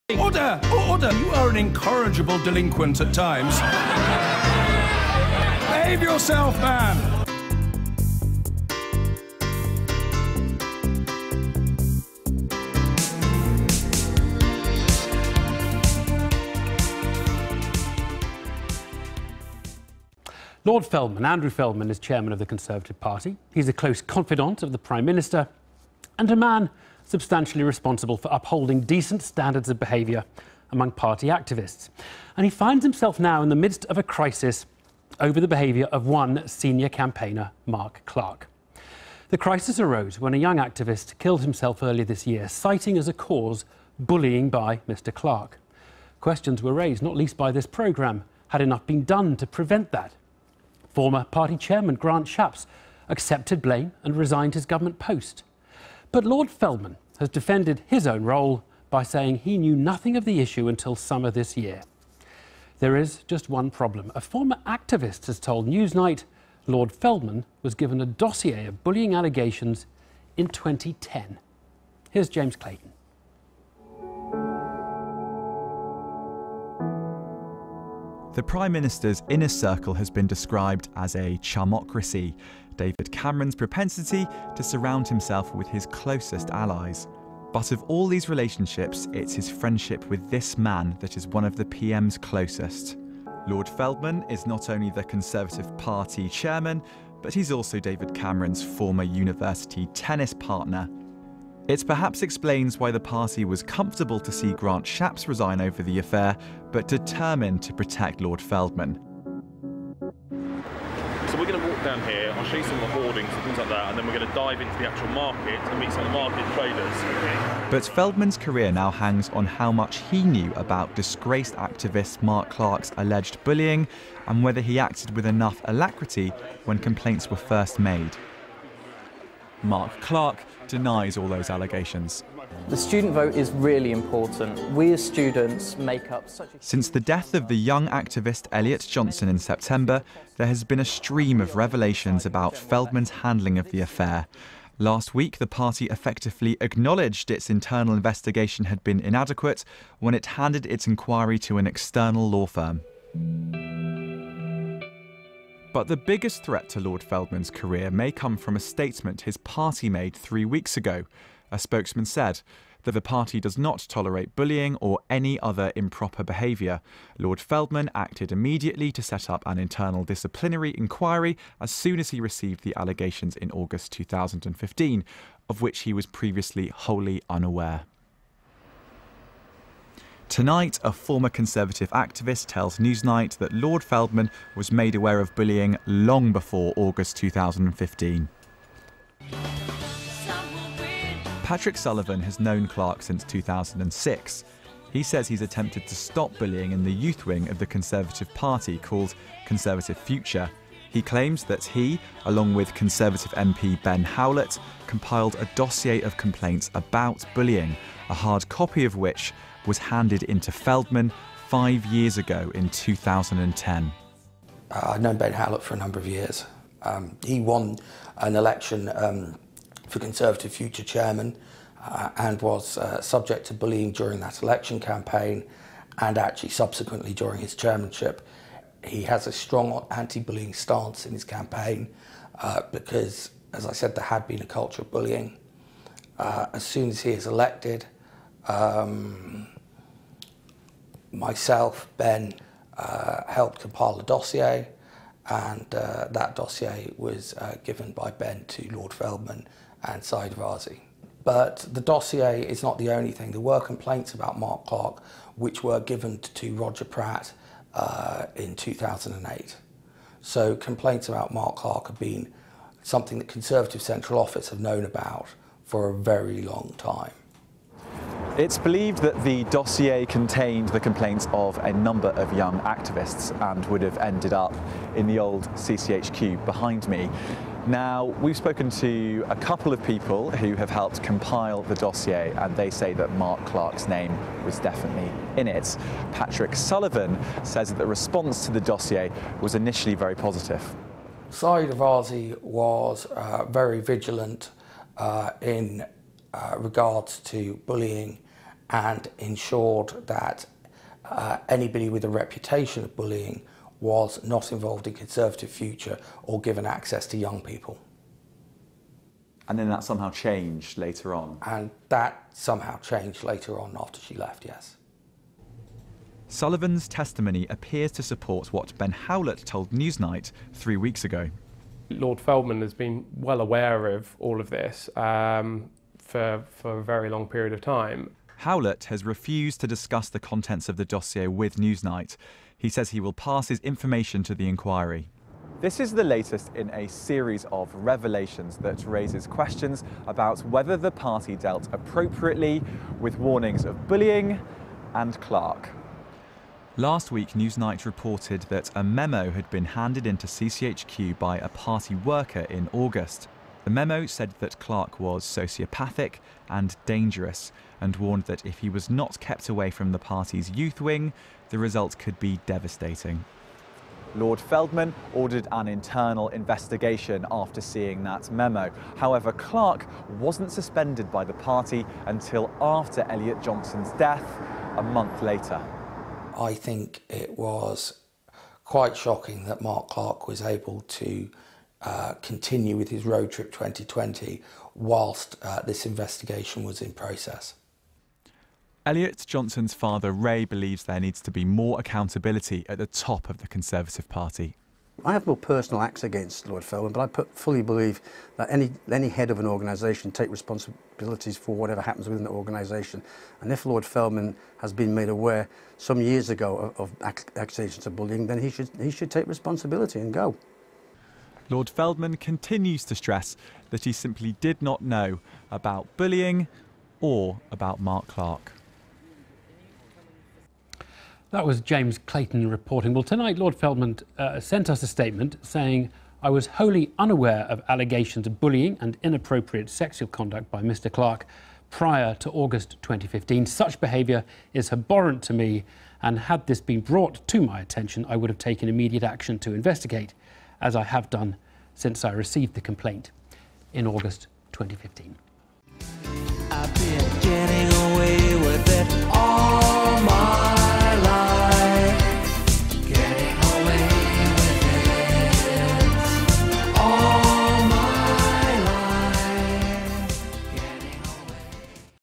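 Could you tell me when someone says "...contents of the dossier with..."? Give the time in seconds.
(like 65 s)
330 s.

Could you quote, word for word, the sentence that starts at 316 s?
Sullivan's testimony appears to support what Ben Howlett told Newsnight three weeks ago.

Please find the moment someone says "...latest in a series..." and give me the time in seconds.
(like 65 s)
336 s.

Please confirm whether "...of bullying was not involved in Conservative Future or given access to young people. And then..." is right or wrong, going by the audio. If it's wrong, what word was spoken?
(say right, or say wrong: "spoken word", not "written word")
right.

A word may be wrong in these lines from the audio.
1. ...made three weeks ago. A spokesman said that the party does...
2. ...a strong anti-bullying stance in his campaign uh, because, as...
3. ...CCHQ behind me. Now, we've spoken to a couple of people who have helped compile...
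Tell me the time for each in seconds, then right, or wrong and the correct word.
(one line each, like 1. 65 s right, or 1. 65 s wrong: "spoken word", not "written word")
1. 159 s right
2. 229 s right
3. 275 s right.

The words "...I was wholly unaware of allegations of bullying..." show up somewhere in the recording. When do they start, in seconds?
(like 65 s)
426 s.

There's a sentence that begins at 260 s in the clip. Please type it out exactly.
So complaints about Mark Clarke have been something that Conservative Central Office have known about for a very long time.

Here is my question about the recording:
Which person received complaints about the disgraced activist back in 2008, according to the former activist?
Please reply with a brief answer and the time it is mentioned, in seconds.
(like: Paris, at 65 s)
Roger Pratt, at 256 s.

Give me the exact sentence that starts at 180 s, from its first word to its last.
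Tonight, a former Conservative activist tells Newsnight that Lord Feldman was made aware of bullying long before August 2015.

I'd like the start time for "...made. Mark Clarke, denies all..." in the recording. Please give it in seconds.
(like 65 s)
127 s.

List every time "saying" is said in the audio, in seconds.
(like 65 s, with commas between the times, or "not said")
59 s, 425 s.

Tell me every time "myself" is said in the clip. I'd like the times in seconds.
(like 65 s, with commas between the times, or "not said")
241 s.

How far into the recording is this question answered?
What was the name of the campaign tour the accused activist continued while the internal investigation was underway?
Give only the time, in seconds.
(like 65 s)
383 s.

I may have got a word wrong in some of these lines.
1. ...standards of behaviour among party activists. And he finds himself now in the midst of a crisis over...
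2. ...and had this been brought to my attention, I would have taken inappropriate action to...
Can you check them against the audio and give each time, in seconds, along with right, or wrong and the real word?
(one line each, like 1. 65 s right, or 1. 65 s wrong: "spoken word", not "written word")
1. 29 s right
2. 436 s wrong: "immediate", not "inappropriate".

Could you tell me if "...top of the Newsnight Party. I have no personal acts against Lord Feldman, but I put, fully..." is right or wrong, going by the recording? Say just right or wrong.
wrong.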